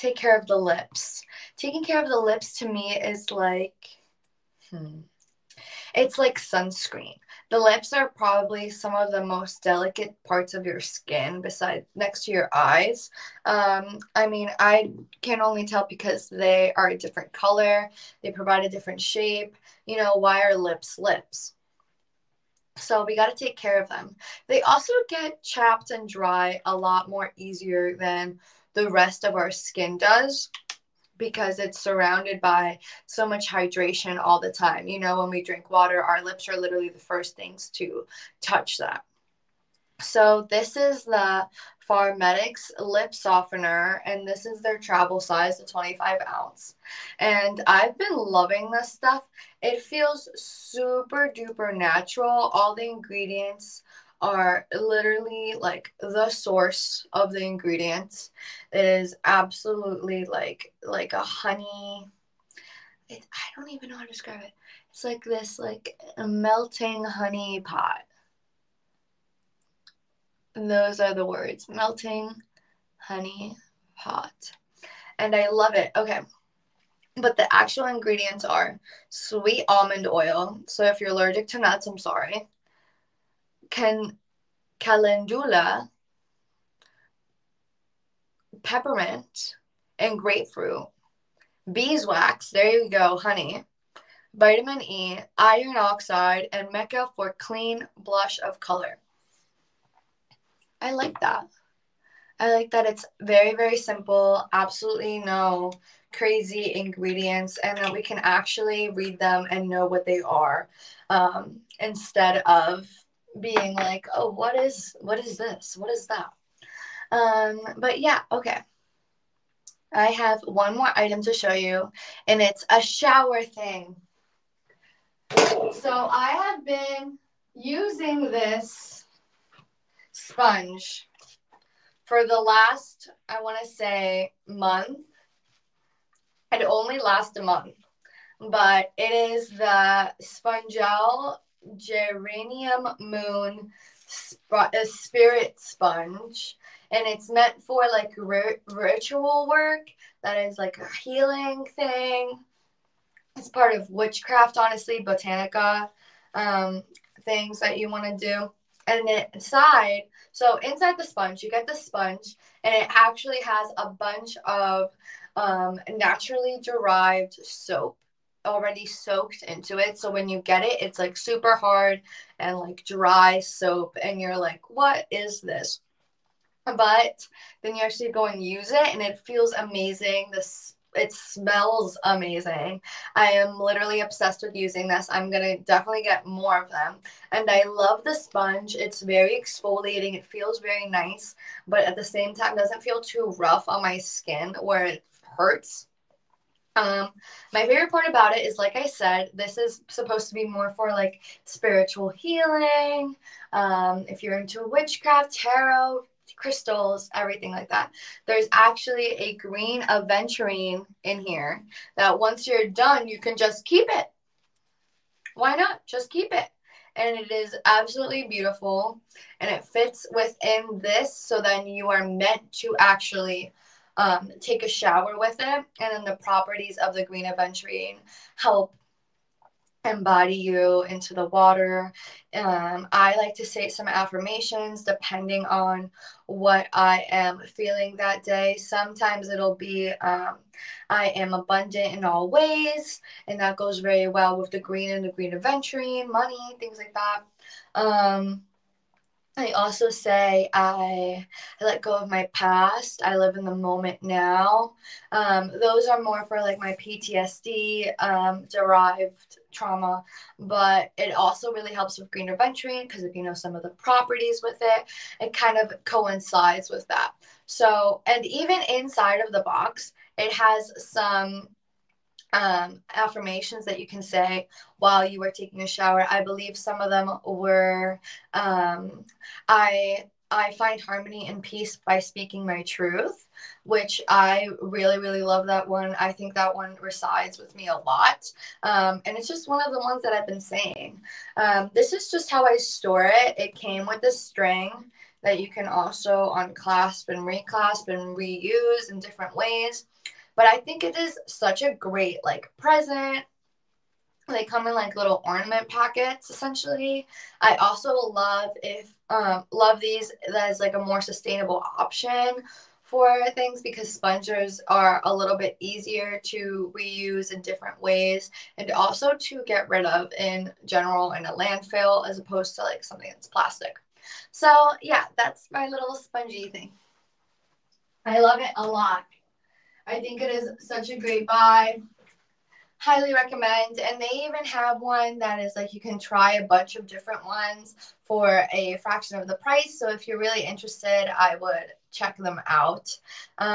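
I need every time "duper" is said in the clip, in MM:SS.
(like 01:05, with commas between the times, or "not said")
00:51.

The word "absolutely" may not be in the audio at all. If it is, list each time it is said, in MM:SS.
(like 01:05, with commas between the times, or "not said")
00:59, 01:44, 03:37.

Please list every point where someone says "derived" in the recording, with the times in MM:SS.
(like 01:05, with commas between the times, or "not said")
02:46, 04:18.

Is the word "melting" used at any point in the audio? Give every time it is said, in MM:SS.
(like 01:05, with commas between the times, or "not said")
01:06, 01:11.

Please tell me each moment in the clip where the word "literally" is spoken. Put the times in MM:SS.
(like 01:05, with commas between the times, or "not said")
00:36, 00:54, 03:03.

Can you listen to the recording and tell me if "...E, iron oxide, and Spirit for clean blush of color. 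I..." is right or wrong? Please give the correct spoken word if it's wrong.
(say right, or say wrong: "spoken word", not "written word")
wrong: "Mecca", not "Spirit".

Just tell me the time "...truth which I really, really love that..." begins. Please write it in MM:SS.
04:42.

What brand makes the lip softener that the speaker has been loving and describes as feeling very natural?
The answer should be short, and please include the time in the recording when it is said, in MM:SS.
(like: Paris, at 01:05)
Farmaesthetics, at 00:41.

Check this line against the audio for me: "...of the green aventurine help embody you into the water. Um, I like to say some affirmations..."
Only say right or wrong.
right.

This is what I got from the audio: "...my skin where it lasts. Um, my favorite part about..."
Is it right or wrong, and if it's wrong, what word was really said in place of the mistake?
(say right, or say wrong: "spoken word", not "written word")
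wrong: "hurts", not "lasts".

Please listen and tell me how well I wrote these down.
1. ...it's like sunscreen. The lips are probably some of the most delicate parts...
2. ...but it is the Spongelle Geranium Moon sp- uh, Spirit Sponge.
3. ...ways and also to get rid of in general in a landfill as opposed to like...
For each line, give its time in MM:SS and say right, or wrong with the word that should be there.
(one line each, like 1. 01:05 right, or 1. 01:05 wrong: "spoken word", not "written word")
1. 00:05 right
2. 02:18 right
3. 05:17 right.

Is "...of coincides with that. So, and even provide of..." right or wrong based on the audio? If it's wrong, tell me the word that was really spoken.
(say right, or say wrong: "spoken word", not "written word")
wrong: "inside", not "provide".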